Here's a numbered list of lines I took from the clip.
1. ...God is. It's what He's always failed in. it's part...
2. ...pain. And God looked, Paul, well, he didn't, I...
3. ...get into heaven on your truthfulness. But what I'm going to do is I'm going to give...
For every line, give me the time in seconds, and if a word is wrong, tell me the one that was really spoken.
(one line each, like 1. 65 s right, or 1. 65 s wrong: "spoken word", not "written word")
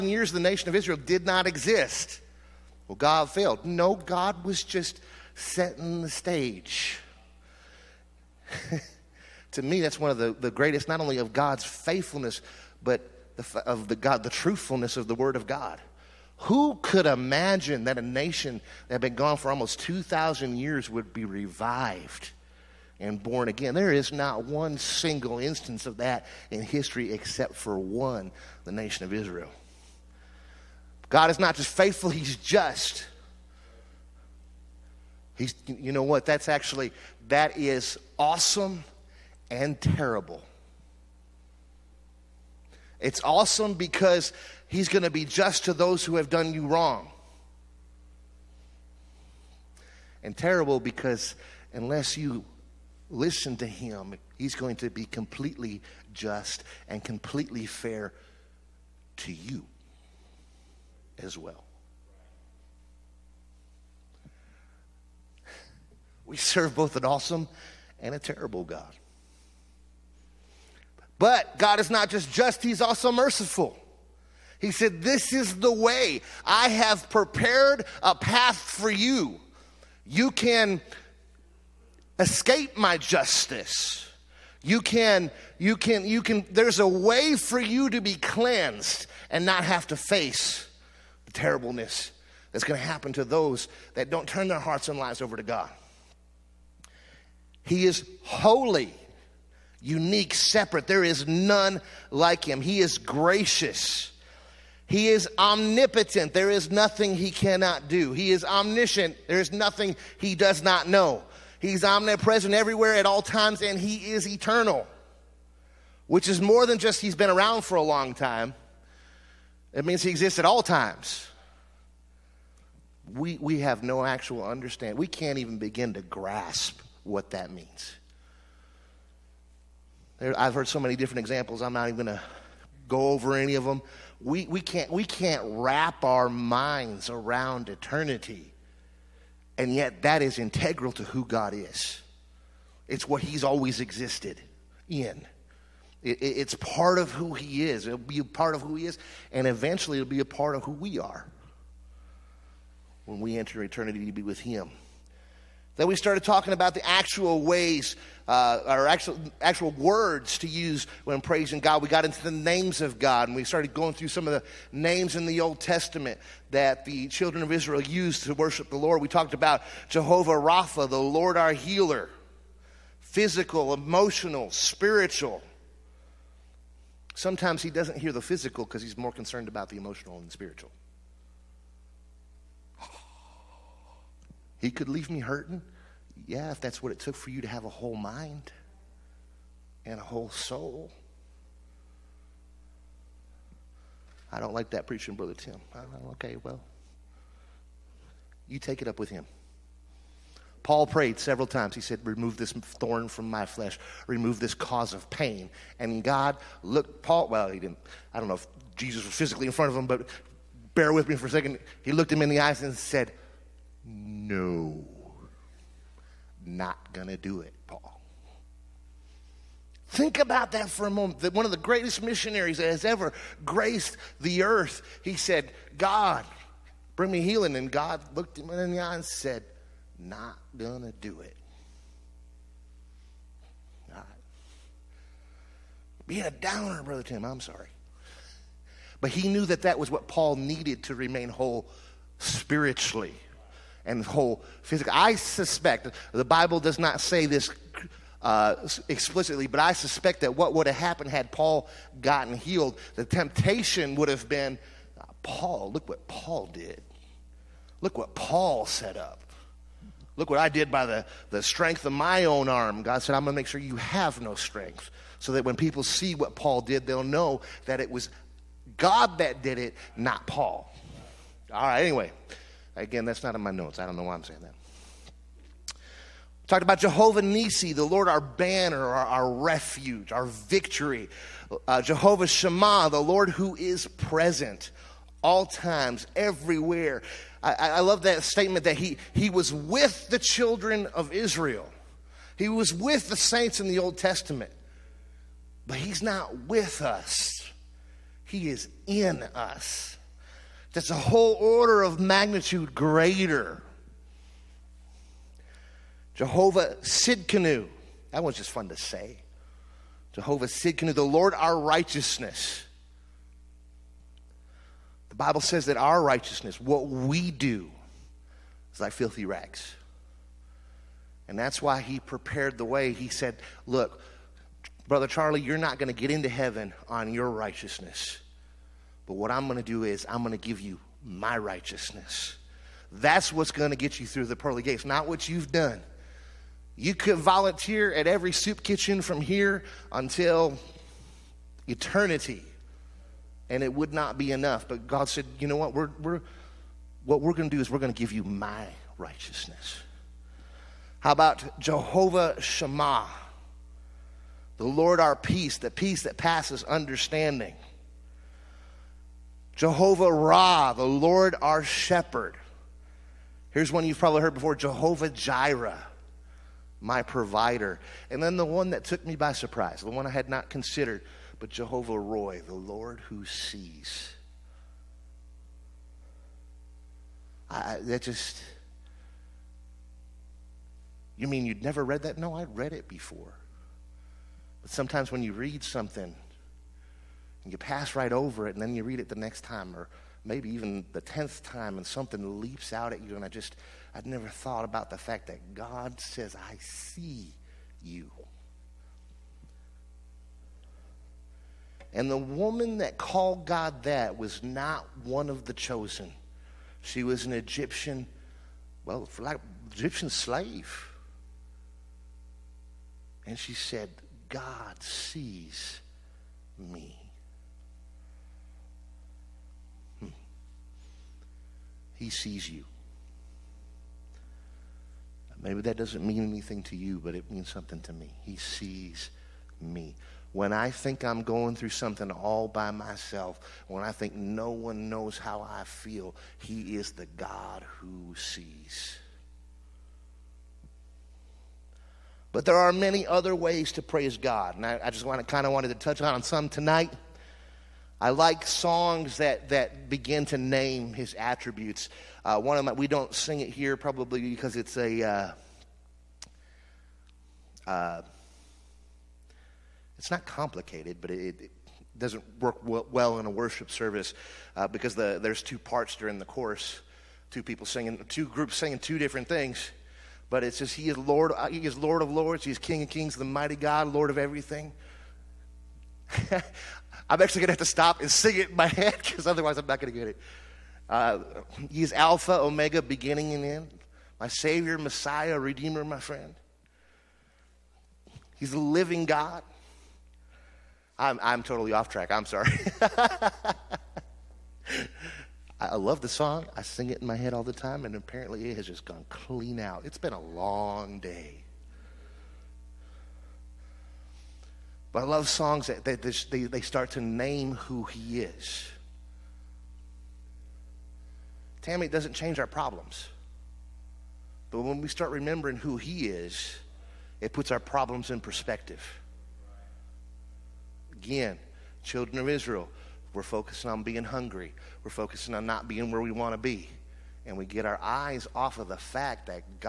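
1. 141 s wrong: "existed", not "failed"
2. 205 s right
3. 325 s wrong: "righteousness", not "truthfulness".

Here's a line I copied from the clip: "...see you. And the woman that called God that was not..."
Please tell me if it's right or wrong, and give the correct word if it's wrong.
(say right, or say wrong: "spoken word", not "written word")
right.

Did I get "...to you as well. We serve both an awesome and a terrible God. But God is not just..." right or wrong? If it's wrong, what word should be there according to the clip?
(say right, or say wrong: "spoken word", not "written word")
right.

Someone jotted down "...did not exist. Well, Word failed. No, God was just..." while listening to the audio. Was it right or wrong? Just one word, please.
wrong.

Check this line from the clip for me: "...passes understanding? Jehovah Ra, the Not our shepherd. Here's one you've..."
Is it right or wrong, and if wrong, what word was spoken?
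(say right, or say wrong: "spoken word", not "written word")
wrong: "Lord", not "Not".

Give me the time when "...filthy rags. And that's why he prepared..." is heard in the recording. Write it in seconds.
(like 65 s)
318 s.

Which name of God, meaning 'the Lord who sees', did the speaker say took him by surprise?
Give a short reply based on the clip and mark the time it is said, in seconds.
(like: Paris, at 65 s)
Jehovah Roi, at 371 s.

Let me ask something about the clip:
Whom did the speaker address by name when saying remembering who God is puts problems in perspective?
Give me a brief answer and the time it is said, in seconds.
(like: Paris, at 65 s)
Tammy, at 511 s.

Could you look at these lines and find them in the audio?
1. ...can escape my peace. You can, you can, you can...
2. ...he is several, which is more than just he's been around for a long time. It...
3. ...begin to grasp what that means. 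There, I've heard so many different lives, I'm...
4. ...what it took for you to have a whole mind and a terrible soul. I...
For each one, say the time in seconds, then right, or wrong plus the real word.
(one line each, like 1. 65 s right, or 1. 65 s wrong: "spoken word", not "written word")
1. 80 s wrong: "justice", not "peace"
2. 113 s wrong: "eternal", not "several"
3. 125 s wrong: "examples", not "lives"
4. 186 s wrong: "whole", not "terrible".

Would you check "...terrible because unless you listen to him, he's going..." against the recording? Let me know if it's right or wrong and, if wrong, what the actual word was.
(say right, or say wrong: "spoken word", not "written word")
right.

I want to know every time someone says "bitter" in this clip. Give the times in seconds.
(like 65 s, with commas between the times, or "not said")
not said.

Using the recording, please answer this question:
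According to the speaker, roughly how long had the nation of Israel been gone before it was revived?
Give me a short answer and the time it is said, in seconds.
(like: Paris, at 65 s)
almost 2,000 years, at 19 s.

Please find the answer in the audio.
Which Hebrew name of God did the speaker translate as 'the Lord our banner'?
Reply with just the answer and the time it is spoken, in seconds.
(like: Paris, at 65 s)
Jehovah Nisi, at 276 s.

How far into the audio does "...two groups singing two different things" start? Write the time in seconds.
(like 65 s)
468 s.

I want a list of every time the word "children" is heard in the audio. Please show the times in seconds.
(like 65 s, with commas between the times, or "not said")
167 s, 290 s, 521 s.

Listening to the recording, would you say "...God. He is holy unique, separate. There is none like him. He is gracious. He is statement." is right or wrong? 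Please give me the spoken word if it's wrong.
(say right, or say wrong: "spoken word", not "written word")
wrong: "omnipotent", not "statement".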